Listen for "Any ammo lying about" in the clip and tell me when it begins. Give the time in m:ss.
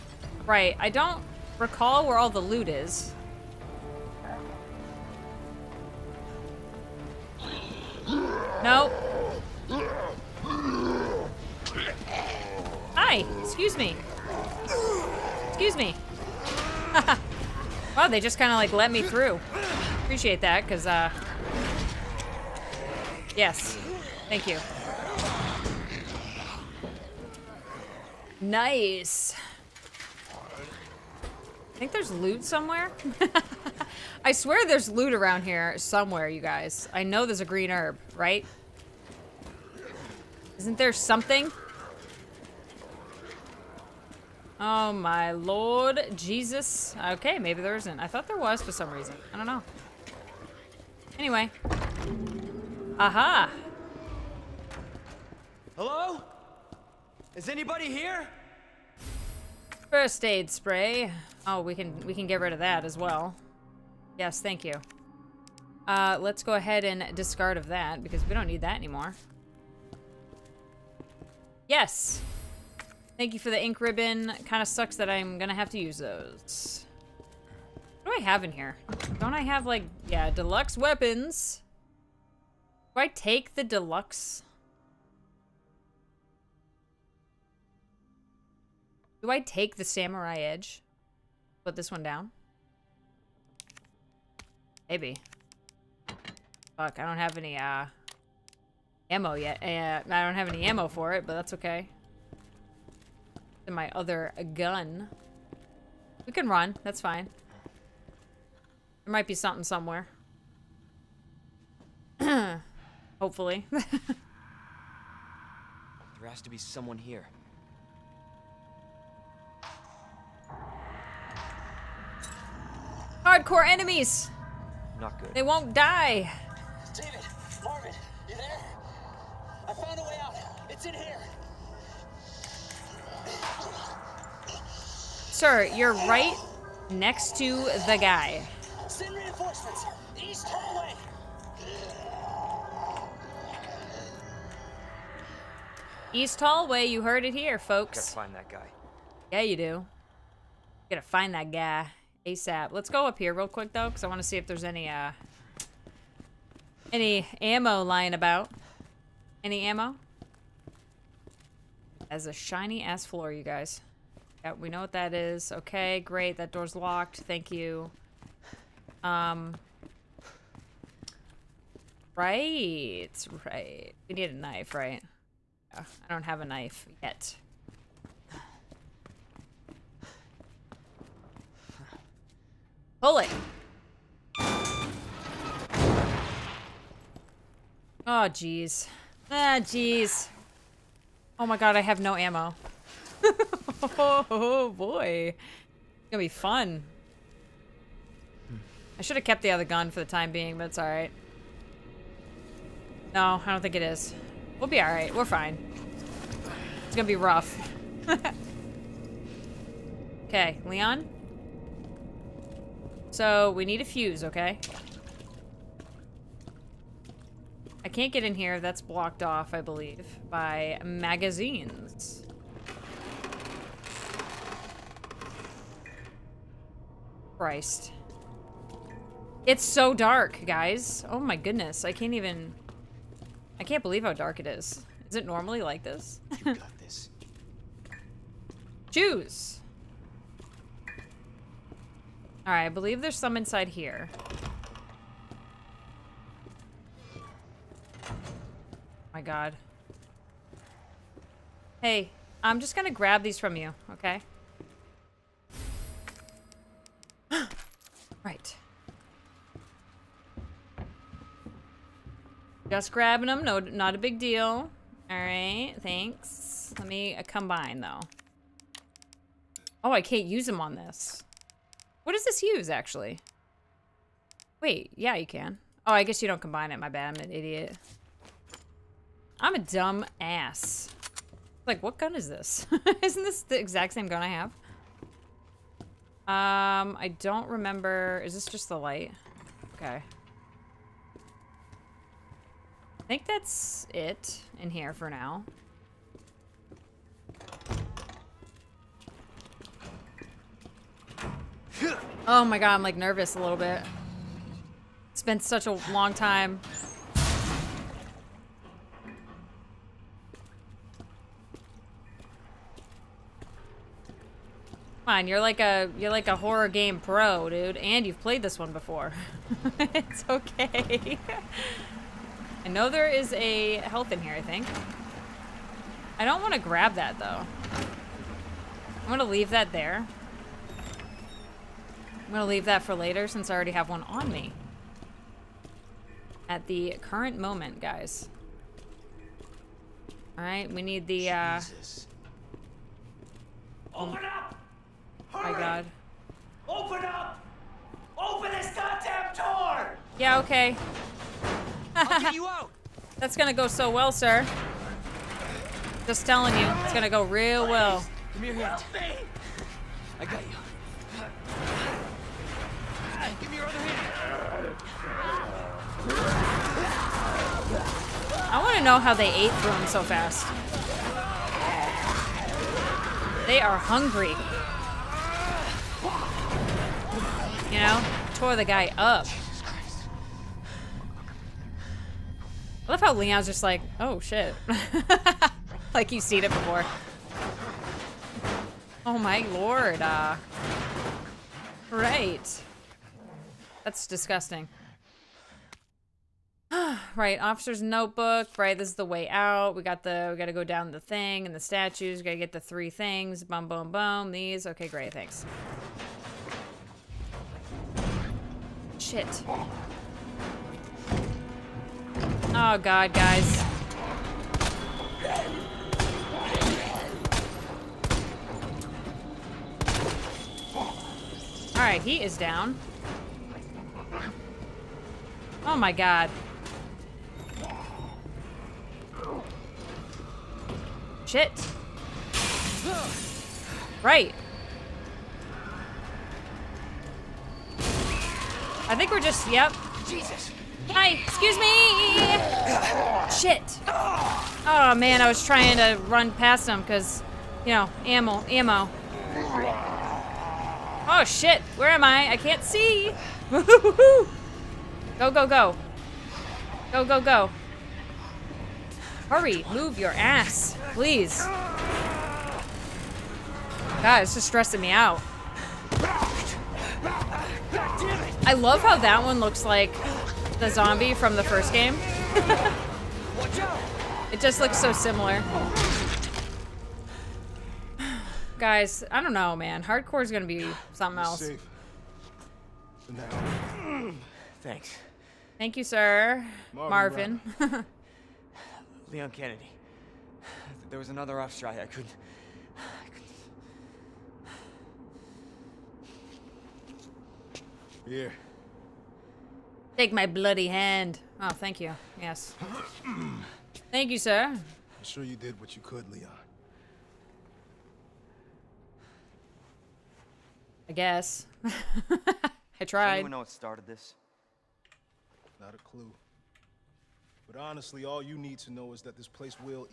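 2:36.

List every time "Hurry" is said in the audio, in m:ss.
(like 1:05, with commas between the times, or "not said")
5:45, 7:39.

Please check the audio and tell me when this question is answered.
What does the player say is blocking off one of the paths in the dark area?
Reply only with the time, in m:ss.
3:40.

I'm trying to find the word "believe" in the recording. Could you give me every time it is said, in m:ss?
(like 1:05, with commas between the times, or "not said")
3:39, 3:53, 4:02.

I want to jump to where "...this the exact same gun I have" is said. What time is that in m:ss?
4:43.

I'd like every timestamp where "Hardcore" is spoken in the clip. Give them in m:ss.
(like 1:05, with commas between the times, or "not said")
2:03, 7:59.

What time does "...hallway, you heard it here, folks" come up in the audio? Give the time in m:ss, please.
2:26.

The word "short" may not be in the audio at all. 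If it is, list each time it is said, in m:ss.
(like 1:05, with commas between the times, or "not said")
not said.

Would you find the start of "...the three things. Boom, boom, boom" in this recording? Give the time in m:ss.
6:42.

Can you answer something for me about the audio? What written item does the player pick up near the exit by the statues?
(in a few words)
Officer's notebook.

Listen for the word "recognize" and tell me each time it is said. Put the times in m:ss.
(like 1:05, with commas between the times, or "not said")
not said.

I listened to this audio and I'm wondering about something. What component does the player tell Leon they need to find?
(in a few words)
A fuse.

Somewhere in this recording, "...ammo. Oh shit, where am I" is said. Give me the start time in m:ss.
7:28.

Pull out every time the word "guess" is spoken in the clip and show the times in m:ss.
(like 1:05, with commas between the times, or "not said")
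4:36, 8:30.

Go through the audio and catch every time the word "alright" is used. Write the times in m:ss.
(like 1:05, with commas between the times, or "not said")
3:20, 3:24, 4:25, 5:40.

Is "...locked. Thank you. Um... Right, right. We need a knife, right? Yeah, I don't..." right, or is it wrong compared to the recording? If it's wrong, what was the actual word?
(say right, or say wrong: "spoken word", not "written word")
right.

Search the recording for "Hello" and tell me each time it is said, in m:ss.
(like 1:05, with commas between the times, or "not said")
0:55.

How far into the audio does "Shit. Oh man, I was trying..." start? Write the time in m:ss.
7:23.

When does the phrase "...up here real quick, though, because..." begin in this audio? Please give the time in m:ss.
2:33.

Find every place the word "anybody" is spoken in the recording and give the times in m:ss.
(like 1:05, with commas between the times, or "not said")
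0:57.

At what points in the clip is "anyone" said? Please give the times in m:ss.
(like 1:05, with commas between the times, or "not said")
8:33.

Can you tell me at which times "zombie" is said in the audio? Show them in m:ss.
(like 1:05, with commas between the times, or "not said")
7:50.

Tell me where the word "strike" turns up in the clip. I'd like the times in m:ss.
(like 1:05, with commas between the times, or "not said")
8:11.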